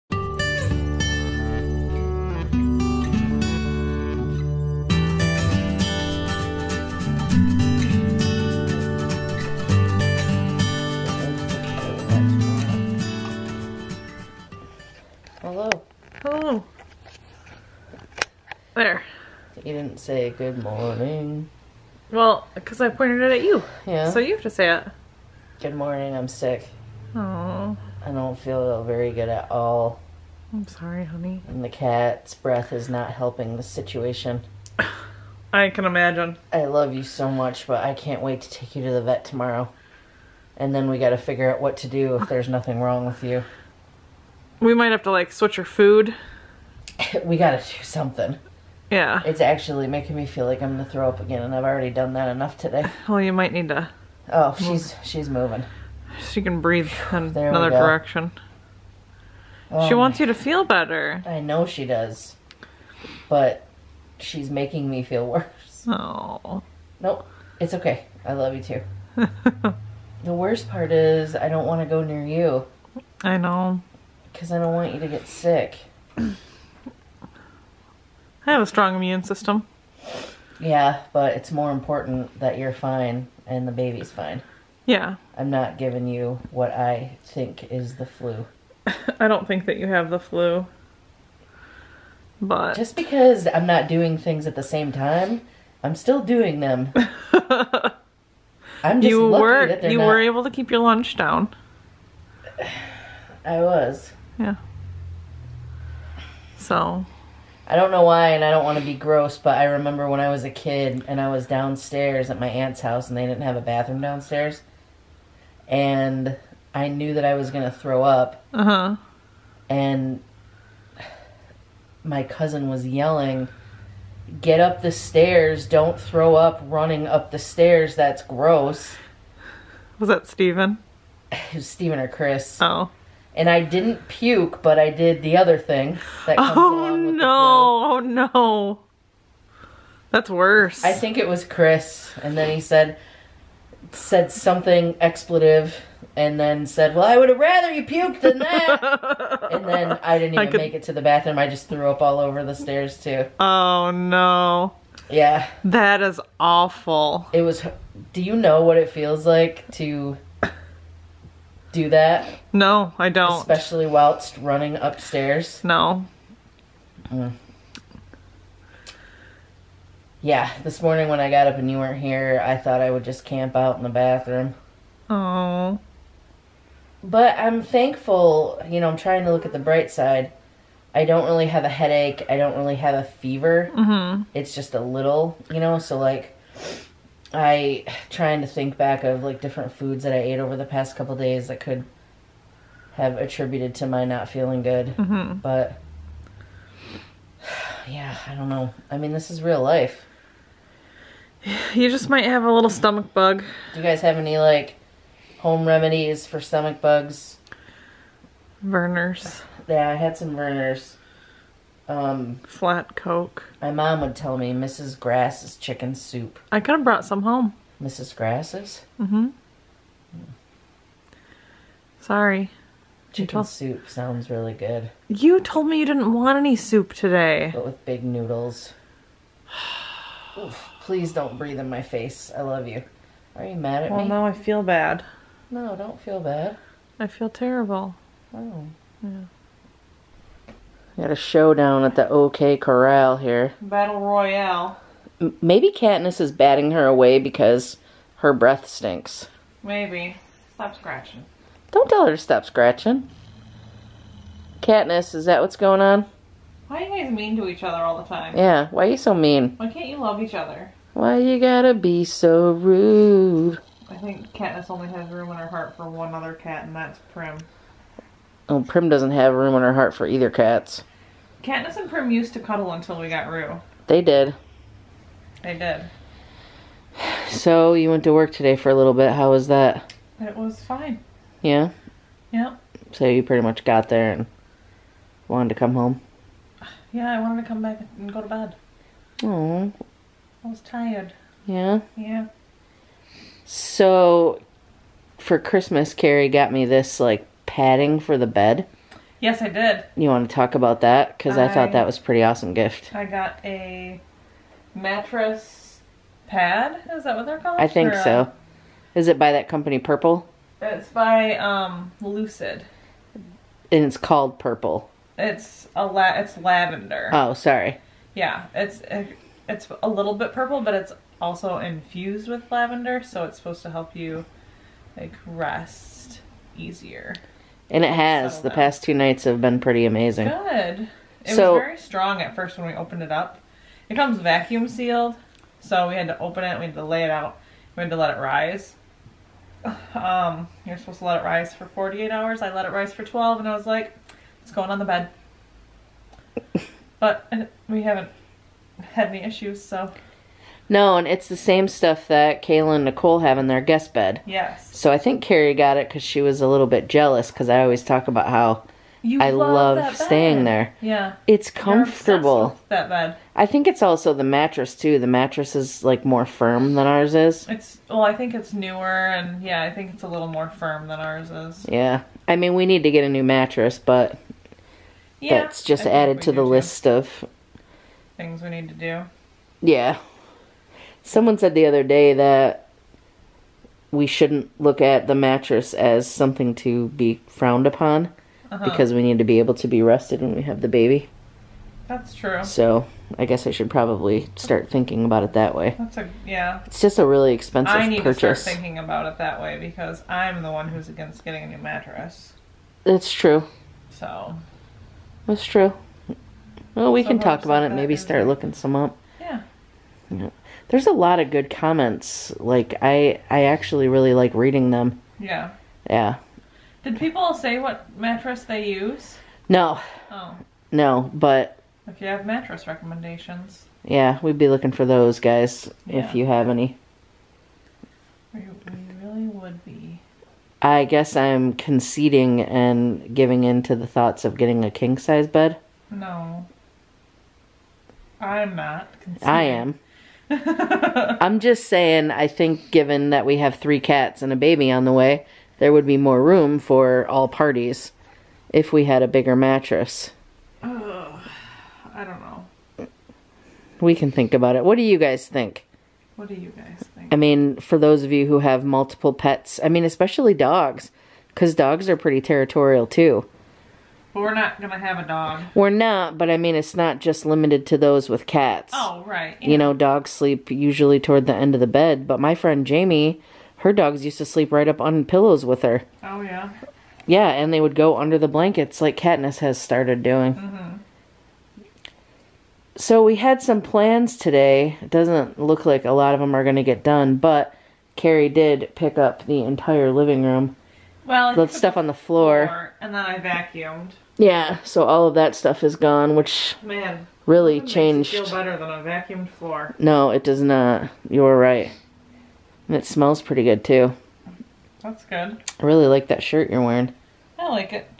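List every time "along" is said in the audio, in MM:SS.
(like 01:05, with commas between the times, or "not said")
02:16.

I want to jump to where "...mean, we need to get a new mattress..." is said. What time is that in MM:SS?
06:12.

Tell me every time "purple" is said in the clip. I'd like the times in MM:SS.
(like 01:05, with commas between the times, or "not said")
05:09, 05:14, 05:20.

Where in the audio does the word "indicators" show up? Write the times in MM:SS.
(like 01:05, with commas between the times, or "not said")
not said.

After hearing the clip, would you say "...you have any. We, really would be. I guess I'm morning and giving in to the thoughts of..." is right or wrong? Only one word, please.
wrong.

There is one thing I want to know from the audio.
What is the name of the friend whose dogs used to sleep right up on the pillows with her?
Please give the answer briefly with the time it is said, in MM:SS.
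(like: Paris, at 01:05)
Jamie, at 07:52.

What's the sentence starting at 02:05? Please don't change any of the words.
Don't throw up running up the stairs.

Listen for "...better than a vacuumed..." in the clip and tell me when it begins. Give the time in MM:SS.
08:18.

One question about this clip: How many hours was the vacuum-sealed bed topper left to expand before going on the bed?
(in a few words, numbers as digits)
12.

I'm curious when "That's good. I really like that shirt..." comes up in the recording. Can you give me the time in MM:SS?
08:24.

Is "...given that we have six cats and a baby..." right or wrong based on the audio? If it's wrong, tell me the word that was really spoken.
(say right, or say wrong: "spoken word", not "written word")
wrong: "three", not "six".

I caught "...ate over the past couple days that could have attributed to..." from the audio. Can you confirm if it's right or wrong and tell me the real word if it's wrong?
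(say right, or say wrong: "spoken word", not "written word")
right.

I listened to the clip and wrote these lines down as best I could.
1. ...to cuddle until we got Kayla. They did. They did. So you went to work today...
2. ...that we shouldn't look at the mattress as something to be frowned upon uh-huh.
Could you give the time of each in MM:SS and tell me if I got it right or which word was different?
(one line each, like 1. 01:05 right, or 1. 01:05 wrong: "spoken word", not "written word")
1. 04:32 wrong: "Rue", not "Kayla"
2. 06:22 right.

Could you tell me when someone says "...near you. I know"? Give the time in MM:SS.
01:12.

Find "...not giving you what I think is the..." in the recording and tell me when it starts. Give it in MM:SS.
01:25.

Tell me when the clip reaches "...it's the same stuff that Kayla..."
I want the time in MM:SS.
05:51.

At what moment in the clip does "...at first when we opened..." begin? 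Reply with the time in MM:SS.
05:32.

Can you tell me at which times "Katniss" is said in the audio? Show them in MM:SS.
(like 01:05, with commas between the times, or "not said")
04:05, 04:14, 04:24, 04:31, 07:58.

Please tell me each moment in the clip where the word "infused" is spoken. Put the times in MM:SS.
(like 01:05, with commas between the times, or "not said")
05:21.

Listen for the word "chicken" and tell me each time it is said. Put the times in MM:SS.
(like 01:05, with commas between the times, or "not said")
03:35, 03:43.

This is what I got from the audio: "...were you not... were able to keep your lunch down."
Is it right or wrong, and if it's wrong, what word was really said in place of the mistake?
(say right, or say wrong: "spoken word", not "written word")
right.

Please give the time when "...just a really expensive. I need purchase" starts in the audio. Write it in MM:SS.
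06:36.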